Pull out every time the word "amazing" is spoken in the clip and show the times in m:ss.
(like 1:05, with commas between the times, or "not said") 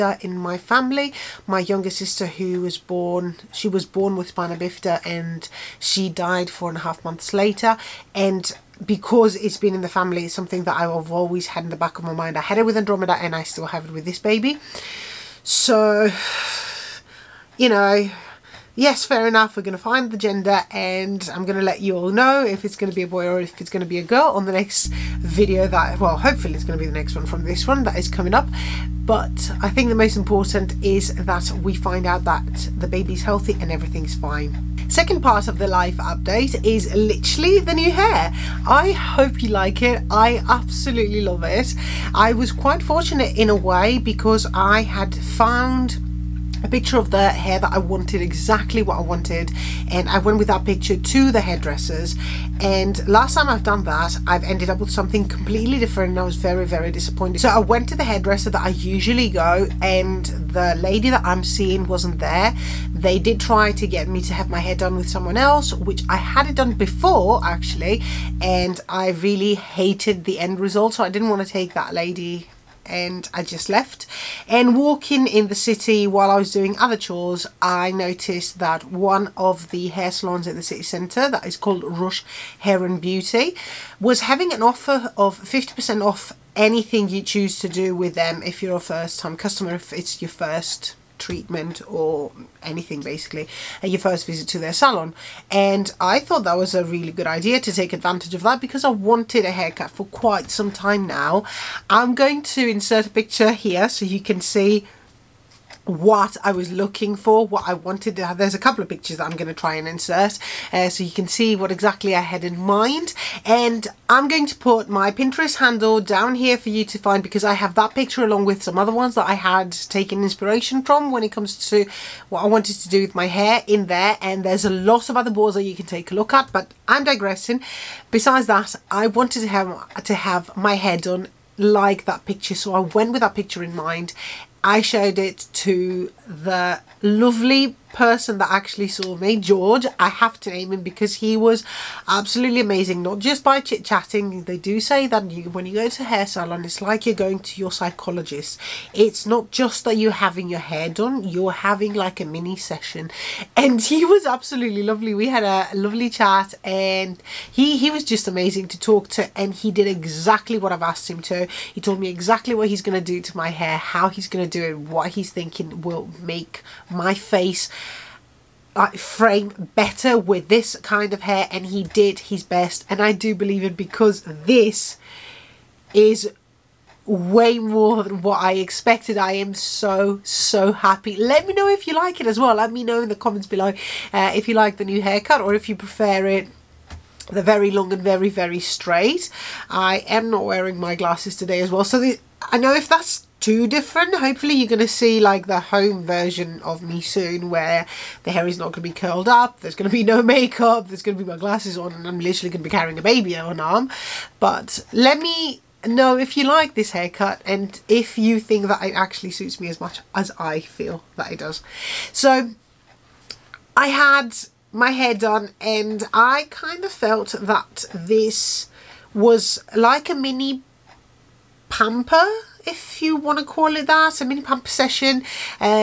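2:22, 2:38.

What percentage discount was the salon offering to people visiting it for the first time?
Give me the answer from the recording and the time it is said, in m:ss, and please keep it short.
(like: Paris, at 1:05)
50%, at 1:25.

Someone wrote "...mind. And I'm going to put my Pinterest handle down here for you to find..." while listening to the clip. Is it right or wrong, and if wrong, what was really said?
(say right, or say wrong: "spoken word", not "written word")
right.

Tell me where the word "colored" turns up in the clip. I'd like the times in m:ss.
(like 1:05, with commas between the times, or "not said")
not said.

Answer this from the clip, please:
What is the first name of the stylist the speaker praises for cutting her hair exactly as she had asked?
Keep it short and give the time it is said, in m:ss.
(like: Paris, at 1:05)
George, at 2:19.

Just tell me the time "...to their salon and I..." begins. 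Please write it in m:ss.
1:34.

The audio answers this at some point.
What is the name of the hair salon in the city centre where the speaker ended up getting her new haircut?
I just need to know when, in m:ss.
1:21.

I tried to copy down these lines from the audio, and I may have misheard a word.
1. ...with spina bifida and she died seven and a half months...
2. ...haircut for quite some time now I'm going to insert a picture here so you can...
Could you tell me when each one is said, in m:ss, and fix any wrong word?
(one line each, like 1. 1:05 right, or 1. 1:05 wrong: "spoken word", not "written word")
1. 0:04 wrong: "four", not "seven"
2. 1:39 right.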